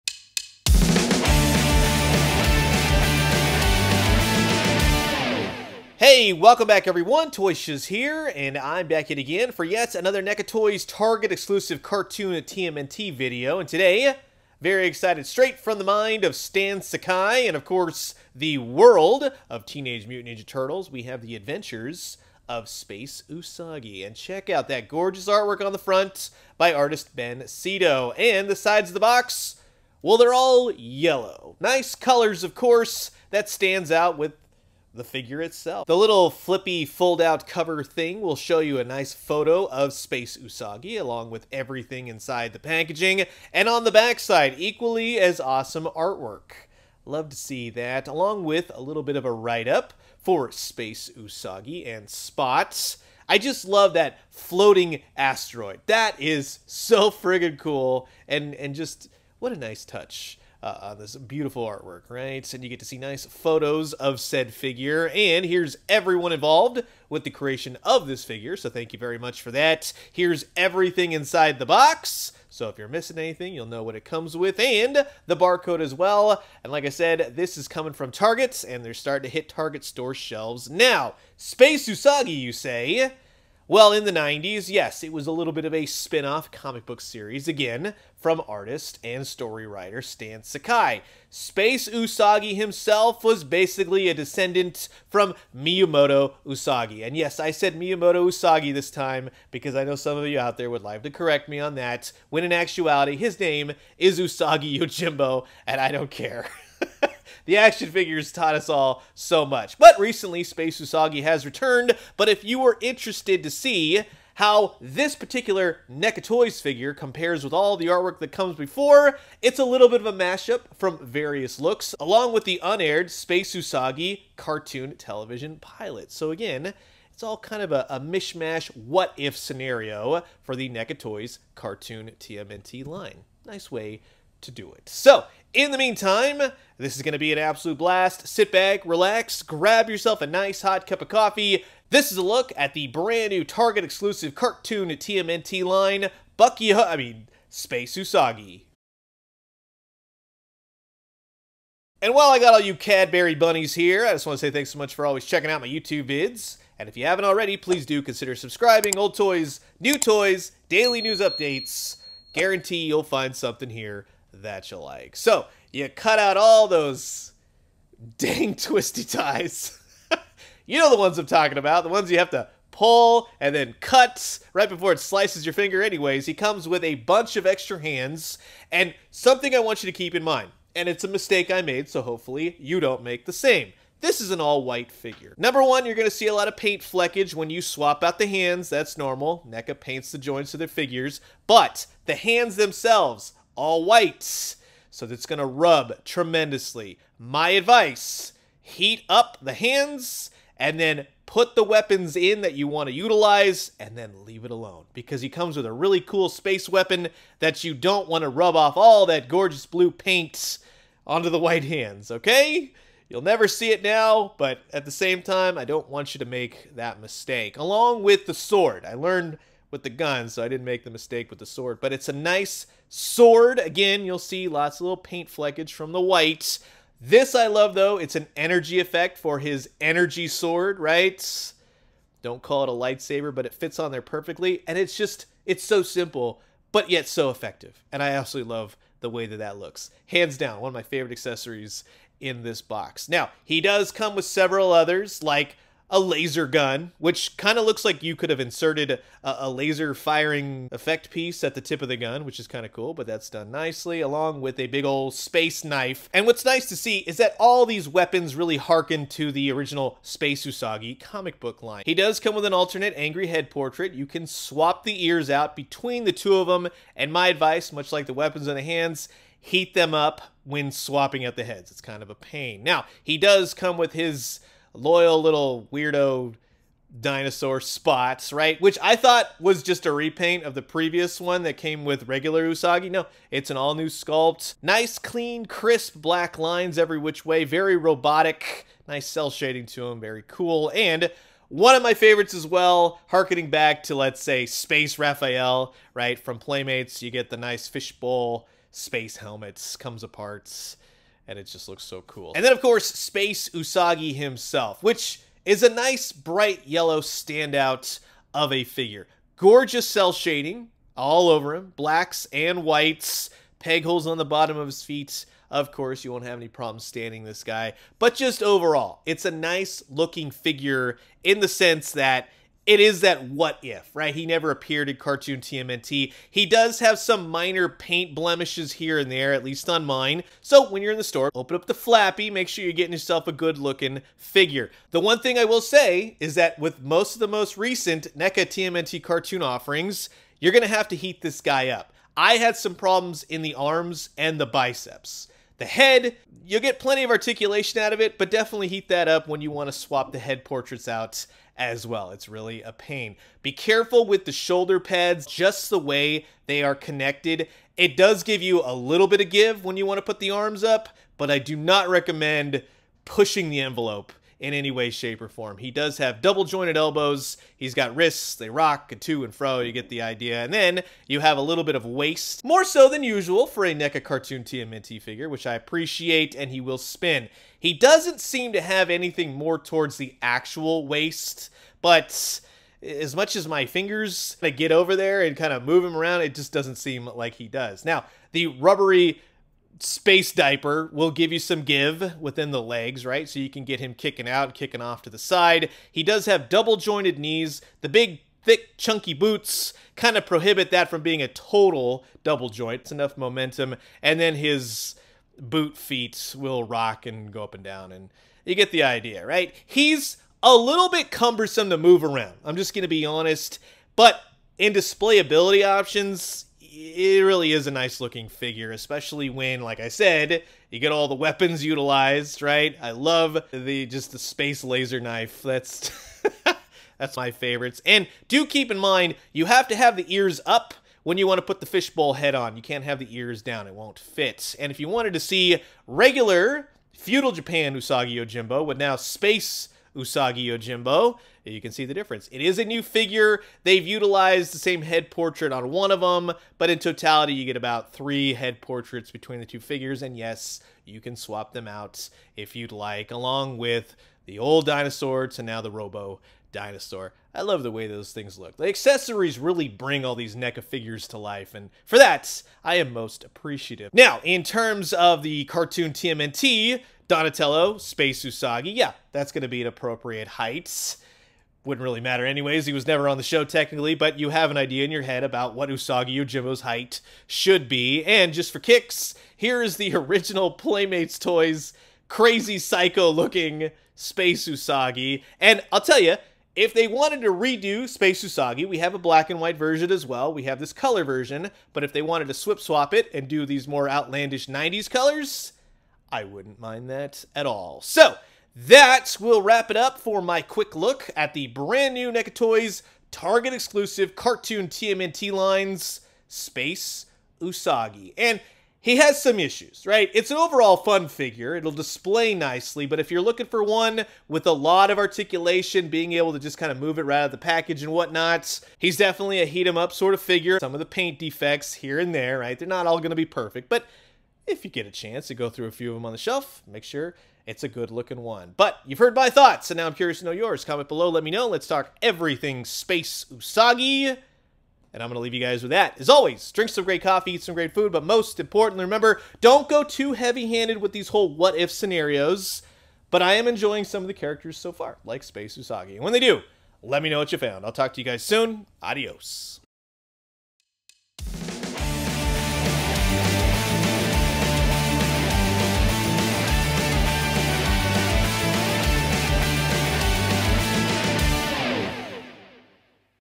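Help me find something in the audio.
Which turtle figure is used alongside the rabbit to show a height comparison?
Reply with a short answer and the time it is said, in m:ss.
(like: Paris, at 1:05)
Donatello, at 7:47.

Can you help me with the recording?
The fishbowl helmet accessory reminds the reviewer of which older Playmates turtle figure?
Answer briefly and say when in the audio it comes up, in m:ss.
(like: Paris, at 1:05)
Space Raphael, at 4:54.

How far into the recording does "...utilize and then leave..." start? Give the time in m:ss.
3:22.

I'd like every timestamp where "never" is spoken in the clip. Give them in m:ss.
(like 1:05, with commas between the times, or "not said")
3:33, 5:24, 7:52.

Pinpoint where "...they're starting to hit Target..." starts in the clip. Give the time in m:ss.
1:18.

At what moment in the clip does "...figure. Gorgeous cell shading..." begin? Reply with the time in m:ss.
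5:08.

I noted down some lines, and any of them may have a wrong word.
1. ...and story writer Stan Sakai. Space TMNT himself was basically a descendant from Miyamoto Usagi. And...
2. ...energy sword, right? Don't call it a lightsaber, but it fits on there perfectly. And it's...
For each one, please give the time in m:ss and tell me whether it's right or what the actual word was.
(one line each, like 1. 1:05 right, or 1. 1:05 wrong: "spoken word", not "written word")
1. 1:29 wrong: "Usagi", not "TMNT"
2. 3:49 right.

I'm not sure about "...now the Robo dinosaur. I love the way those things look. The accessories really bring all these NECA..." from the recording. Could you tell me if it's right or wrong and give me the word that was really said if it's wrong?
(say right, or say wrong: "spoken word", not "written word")
right.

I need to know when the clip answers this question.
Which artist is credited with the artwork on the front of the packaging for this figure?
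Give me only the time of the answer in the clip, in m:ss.
0:27.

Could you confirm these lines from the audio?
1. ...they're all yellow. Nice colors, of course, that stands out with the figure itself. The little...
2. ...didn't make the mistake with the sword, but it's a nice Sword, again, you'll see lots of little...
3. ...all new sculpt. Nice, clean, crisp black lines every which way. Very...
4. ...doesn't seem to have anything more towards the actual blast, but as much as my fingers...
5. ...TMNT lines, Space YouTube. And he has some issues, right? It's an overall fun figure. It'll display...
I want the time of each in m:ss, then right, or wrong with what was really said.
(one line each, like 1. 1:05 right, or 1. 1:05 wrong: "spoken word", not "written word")
1. 0:30 right
2. 3:40 right
3. 4:43 right
4. 6:17 wrong: "waist", not "blast"
5. 8:24 wrong: "Usagi", not "YouTube".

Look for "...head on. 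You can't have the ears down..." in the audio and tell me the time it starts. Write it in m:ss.
7:12.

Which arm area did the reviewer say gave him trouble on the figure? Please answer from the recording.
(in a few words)
Biceps.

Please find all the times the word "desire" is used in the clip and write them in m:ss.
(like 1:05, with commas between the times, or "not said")
not said.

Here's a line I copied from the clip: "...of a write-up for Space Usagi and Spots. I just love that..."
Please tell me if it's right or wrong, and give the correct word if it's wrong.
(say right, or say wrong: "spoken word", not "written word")
right.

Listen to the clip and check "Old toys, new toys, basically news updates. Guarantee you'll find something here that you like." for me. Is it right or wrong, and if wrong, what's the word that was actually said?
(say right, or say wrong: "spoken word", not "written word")
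wrong: "daily", not "basically".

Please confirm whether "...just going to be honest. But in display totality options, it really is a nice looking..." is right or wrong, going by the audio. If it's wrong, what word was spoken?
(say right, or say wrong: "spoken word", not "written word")
wrong: "ability", not "totality".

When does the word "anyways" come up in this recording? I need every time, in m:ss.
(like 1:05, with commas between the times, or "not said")
2:55, 7:52.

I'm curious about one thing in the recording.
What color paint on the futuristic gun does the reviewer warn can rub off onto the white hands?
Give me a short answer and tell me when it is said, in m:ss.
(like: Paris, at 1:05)
Blue, at 3:29.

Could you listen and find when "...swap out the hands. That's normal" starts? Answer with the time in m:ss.
3:07.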